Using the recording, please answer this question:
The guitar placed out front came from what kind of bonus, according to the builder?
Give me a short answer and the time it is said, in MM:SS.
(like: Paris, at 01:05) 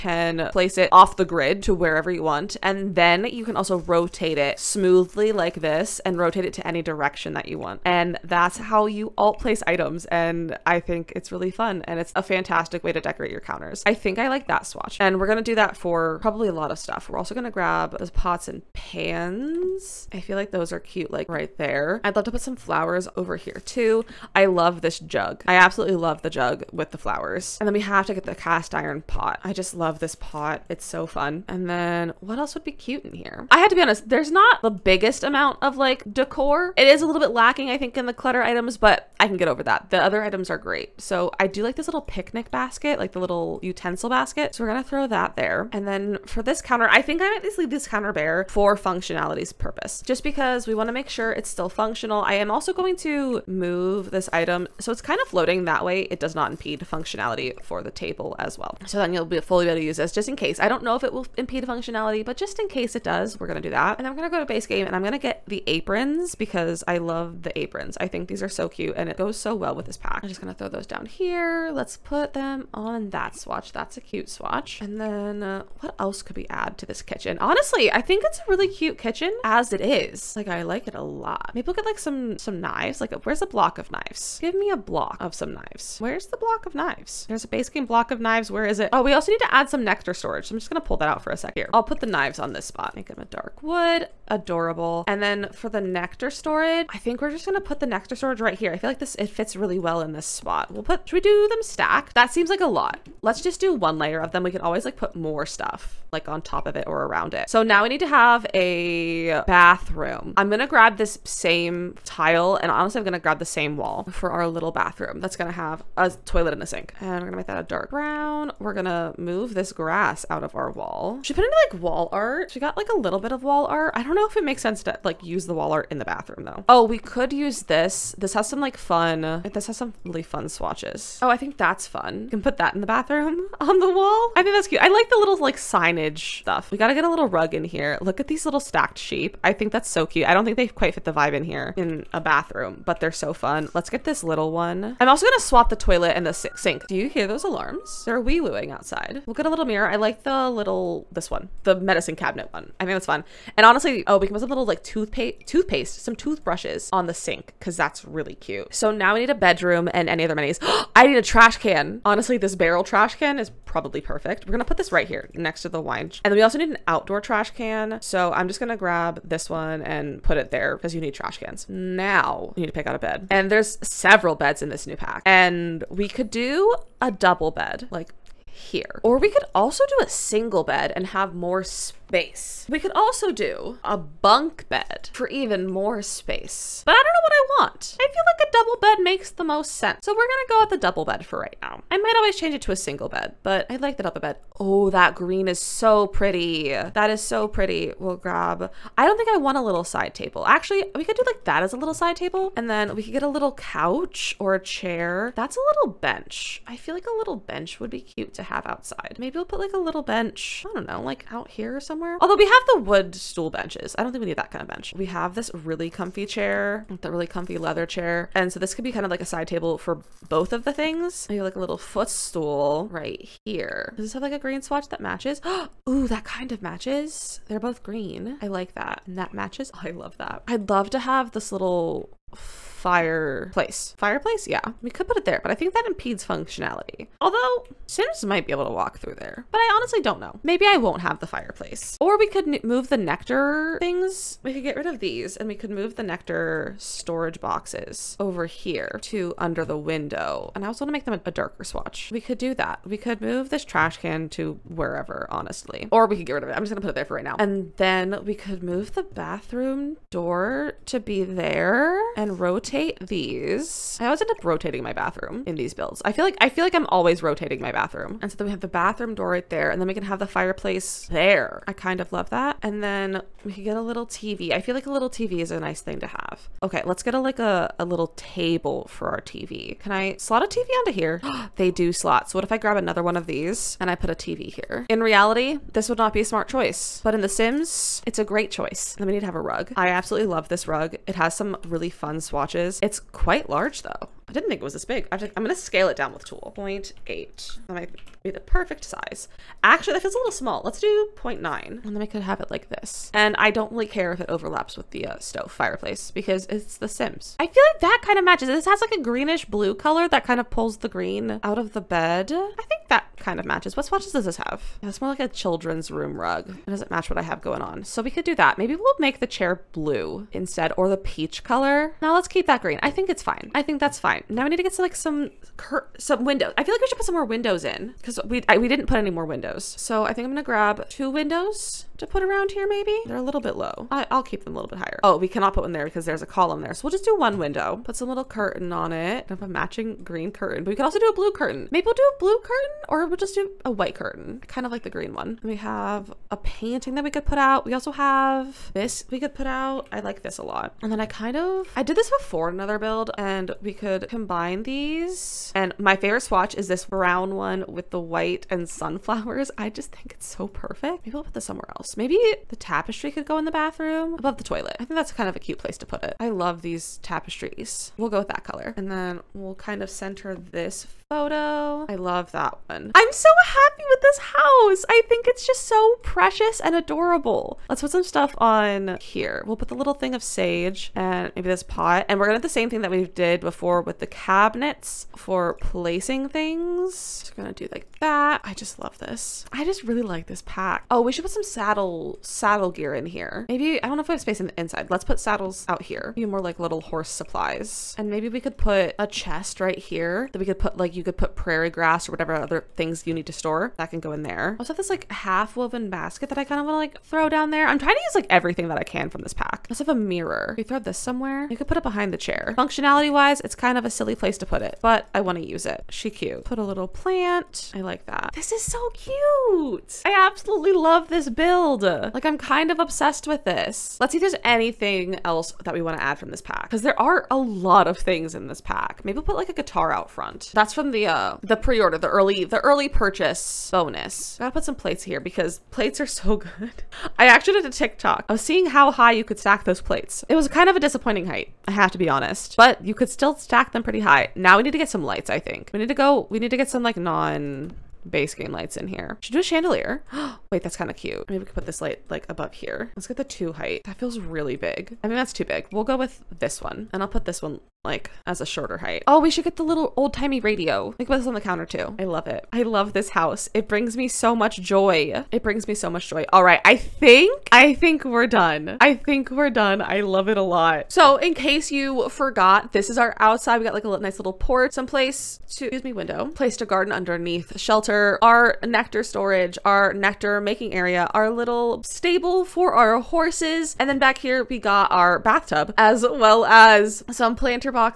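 pre-order, at 07:11.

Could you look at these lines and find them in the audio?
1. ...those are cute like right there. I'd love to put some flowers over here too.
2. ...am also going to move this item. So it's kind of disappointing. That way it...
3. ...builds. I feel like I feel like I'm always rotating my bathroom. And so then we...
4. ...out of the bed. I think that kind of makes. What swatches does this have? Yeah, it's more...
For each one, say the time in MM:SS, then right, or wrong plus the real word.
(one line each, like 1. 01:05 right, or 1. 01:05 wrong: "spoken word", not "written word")
1. 00:20 right
2. 00:52 wrong: "floating", not "disappointing"
3. 04:25 right
4. 05:11 wrong: "matches", not "makes".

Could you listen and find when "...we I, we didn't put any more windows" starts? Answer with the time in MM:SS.
05:28.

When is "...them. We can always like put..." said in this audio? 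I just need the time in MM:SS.
01:44.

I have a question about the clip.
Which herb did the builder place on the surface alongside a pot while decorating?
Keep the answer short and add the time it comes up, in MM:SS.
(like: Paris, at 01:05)
sage, at 06:20.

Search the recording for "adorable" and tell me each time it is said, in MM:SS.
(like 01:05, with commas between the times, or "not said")
01:34, 06:16.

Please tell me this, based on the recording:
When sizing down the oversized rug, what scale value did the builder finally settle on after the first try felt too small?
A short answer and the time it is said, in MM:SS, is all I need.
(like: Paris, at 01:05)
0.9, at 05:01.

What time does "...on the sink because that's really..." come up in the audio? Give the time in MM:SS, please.
02:36.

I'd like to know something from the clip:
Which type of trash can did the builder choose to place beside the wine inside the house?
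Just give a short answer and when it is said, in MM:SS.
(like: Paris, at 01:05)
barrel trash can, at 02:42.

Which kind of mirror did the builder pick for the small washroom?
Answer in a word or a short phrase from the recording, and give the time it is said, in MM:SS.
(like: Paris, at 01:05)
medicine cabinet, at 02:31.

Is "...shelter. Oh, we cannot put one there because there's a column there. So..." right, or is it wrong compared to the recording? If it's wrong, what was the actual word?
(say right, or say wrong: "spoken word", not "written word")
wrong: "higher", not "shelter".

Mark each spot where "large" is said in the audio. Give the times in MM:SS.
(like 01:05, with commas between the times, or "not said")
04:53.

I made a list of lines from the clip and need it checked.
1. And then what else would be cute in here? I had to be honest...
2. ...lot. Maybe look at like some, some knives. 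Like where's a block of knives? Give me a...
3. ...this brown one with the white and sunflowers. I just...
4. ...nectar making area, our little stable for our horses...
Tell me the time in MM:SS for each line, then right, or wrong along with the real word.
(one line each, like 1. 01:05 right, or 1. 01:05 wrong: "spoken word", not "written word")
1. 00:31 right
2. 01:21 right
3. 05:56 right
4. 07:59 right.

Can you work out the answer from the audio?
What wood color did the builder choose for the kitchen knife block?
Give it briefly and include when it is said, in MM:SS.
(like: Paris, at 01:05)
dark wood, at 01:33.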